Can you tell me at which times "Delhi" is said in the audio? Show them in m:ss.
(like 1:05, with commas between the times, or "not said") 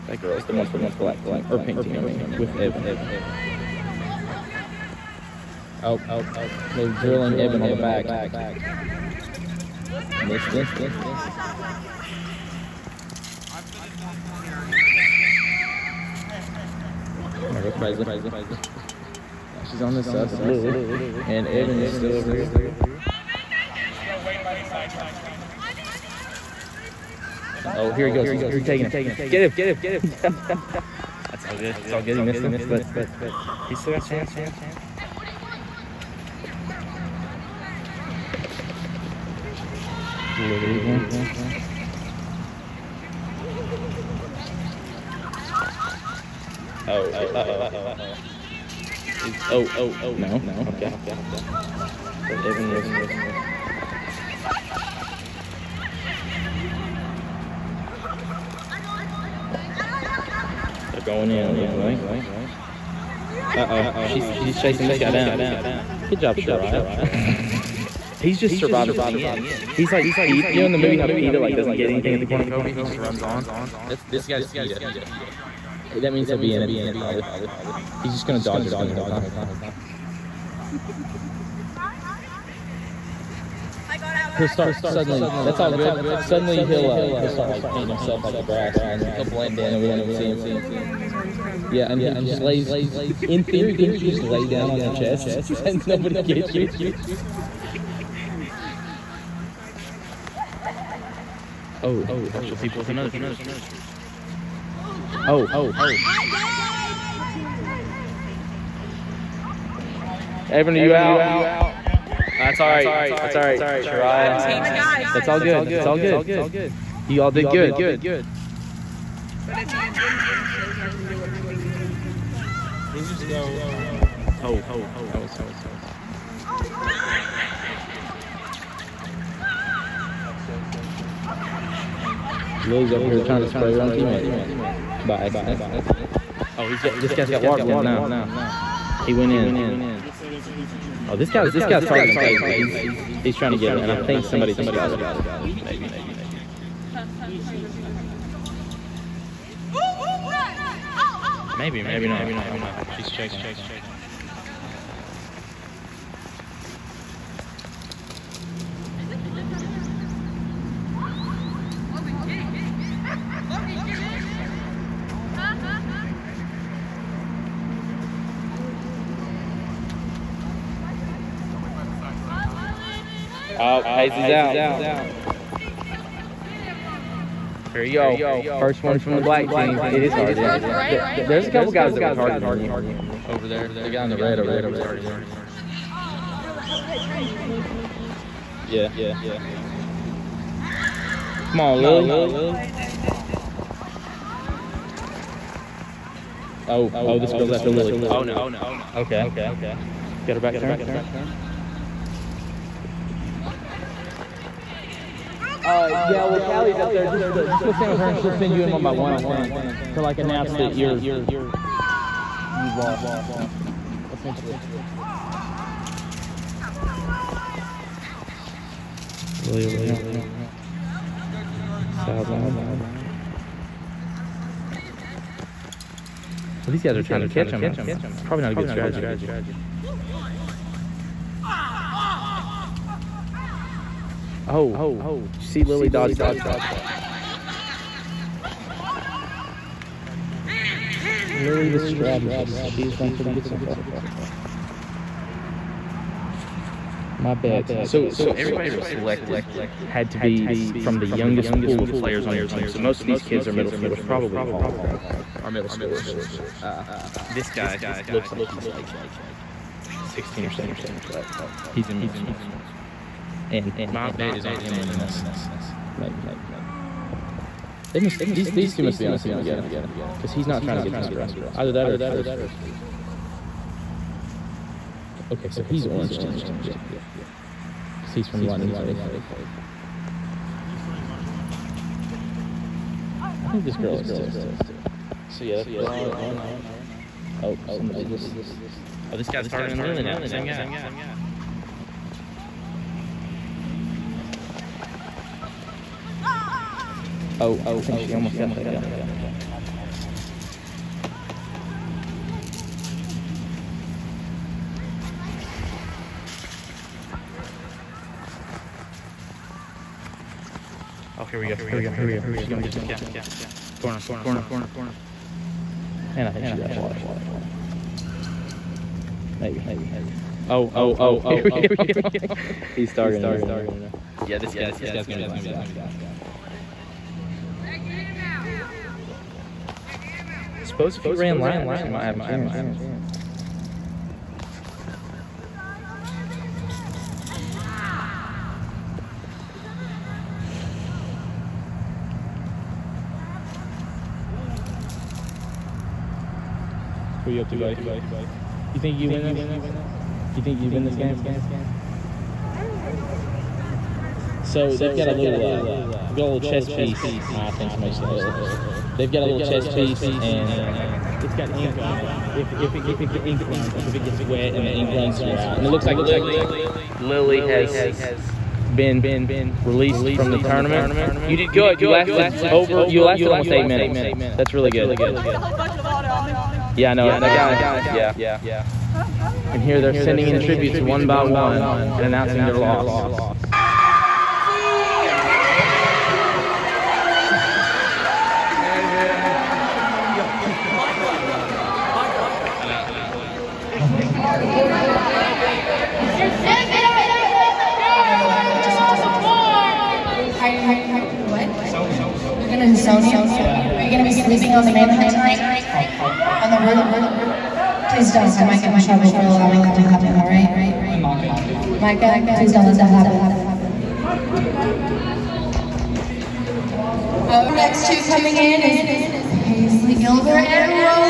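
not said.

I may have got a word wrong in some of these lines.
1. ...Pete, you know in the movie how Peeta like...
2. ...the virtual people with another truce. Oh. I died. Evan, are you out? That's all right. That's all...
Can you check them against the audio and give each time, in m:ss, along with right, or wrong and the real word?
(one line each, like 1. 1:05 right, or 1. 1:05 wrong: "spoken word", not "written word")
1. 1:10 right
2. 1:42 right.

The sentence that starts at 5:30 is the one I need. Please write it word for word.
suppose if you ran laps, you might have a chance.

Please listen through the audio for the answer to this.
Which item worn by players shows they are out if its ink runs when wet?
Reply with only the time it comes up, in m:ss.
5:59.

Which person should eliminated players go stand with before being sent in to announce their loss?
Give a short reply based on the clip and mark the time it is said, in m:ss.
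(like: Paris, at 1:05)
Callie, at 3:26.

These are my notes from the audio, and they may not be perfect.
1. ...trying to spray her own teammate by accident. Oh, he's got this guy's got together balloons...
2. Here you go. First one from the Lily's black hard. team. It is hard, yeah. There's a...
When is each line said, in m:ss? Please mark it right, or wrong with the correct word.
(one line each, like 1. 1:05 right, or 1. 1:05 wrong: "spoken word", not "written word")
1. 2:13 wrong: "water", not "together"
2. 2:57 wrong: "That", not "Lily".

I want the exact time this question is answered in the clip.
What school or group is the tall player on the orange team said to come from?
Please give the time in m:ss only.
4:38.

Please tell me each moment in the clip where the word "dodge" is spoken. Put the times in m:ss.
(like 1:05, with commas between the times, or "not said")
1:18, 3:55.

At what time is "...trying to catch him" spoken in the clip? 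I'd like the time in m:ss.
3:47.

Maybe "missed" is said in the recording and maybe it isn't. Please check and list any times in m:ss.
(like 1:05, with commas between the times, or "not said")
0:10, 0:32.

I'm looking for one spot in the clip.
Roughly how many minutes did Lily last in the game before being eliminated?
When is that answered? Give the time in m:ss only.
6:13.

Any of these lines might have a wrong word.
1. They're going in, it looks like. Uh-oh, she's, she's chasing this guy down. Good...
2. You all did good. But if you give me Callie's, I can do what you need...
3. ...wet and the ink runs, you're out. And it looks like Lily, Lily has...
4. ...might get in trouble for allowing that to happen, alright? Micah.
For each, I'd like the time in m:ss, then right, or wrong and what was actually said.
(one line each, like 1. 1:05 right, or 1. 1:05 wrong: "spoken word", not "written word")
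1. 1:00 right
2. 1:57 wrong: "Ashley", not "Callie"
3. 6:04 right
4. 6:48 right.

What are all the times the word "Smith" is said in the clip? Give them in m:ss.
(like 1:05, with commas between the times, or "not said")
not said.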